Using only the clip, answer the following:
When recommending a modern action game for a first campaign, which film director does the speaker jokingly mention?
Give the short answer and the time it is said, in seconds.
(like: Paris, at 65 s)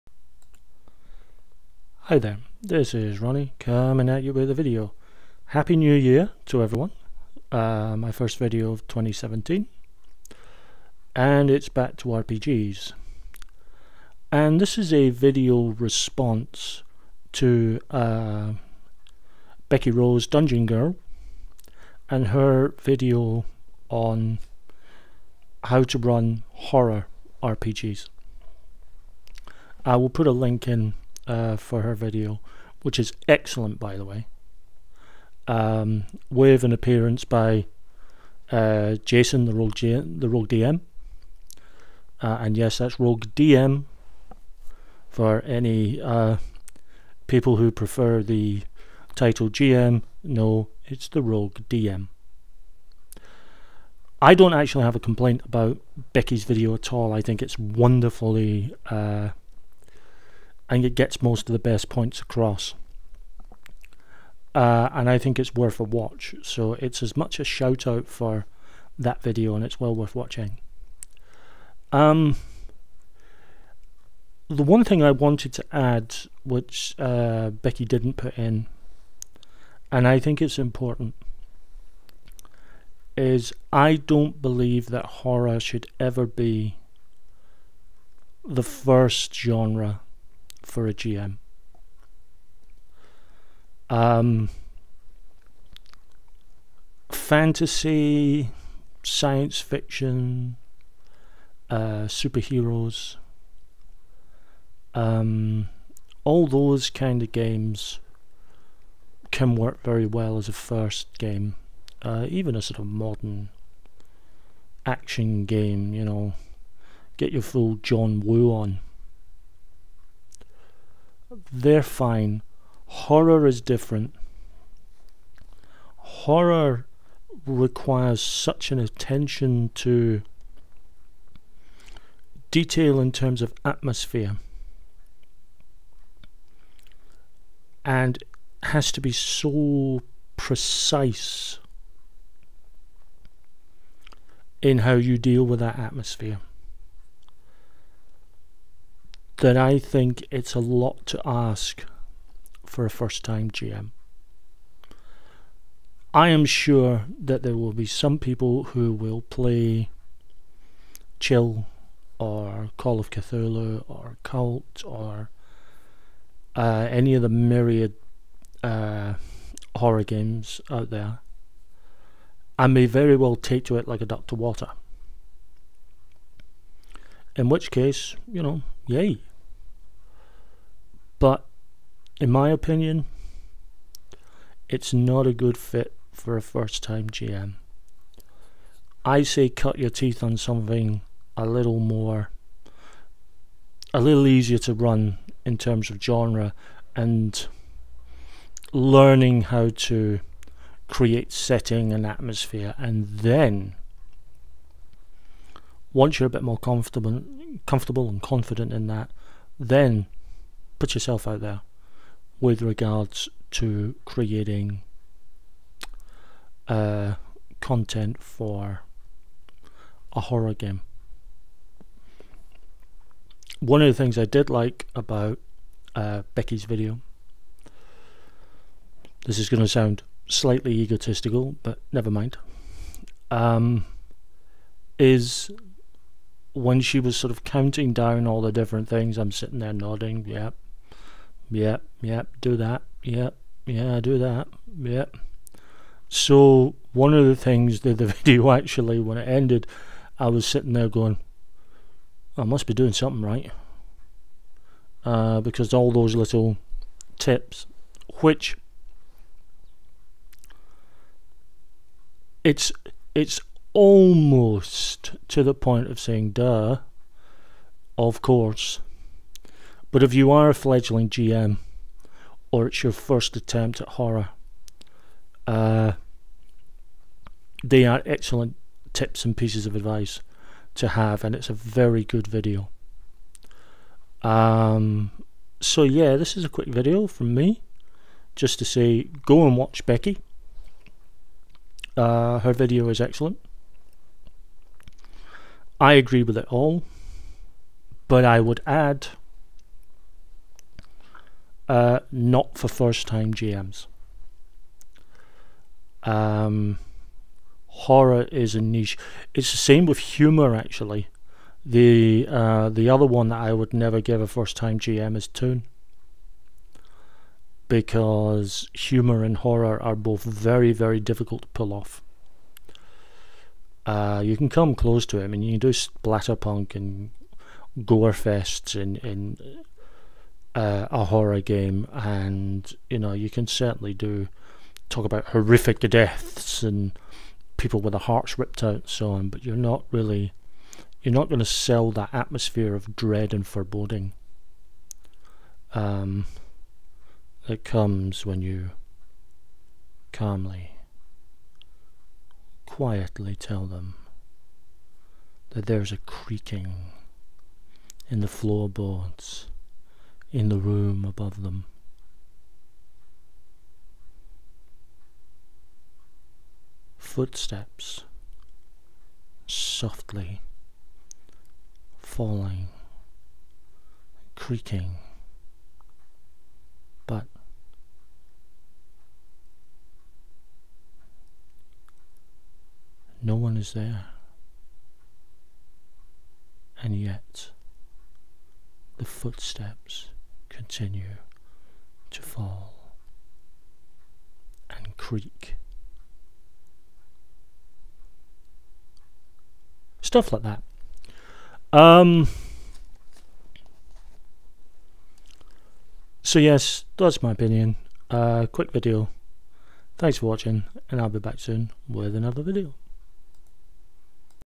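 John Woo, at 117 s.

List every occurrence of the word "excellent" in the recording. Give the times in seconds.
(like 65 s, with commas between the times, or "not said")
33 s, 278 s, 293 s.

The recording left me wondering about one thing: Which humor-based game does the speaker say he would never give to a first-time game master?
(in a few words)
Toon.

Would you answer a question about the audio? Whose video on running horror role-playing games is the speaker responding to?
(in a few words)
Becky Rose Dungeon Girl.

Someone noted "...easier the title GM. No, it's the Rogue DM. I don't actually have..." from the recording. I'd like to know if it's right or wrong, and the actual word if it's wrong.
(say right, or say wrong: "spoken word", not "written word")
wrong: "prefer", not "easier".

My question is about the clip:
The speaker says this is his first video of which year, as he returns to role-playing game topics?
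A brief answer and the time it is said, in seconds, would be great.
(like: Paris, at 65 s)
2017, at 8 s.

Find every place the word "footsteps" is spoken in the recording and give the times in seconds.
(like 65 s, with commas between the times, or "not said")
366 s, 389 s.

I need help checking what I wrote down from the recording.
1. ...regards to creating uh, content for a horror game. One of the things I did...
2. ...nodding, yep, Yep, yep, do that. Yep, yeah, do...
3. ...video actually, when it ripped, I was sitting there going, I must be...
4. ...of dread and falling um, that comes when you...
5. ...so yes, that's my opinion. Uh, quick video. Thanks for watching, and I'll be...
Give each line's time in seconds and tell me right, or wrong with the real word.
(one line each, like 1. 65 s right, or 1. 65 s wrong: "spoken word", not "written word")
1. 212 s right
2. 239 s right
3. 248 s wrong: "ended", not "ripped"
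4. 342 s wrong: "foreboding", not "falling"
5. 406 s right.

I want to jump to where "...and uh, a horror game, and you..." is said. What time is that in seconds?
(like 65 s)
329 s.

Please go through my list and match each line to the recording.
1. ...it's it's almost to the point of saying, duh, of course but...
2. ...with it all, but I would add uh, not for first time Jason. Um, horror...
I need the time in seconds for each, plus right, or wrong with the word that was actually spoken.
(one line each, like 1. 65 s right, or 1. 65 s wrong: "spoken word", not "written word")
1. 262 s right
2. 296 s wrong: "GMs", not "Jason".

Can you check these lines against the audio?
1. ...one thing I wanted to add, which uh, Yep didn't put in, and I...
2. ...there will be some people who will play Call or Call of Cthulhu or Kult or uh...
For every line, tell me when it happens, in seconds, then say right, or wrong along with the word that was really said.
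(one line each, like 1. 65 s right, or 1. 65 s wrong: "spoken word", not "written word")
1. 74 s wrong: "Becky", not "Yep"
2. 157 s wrong: "Chill", not "Call".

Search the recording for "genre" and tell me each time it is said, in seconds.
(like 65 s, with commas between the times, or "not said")
89 s, 196 s.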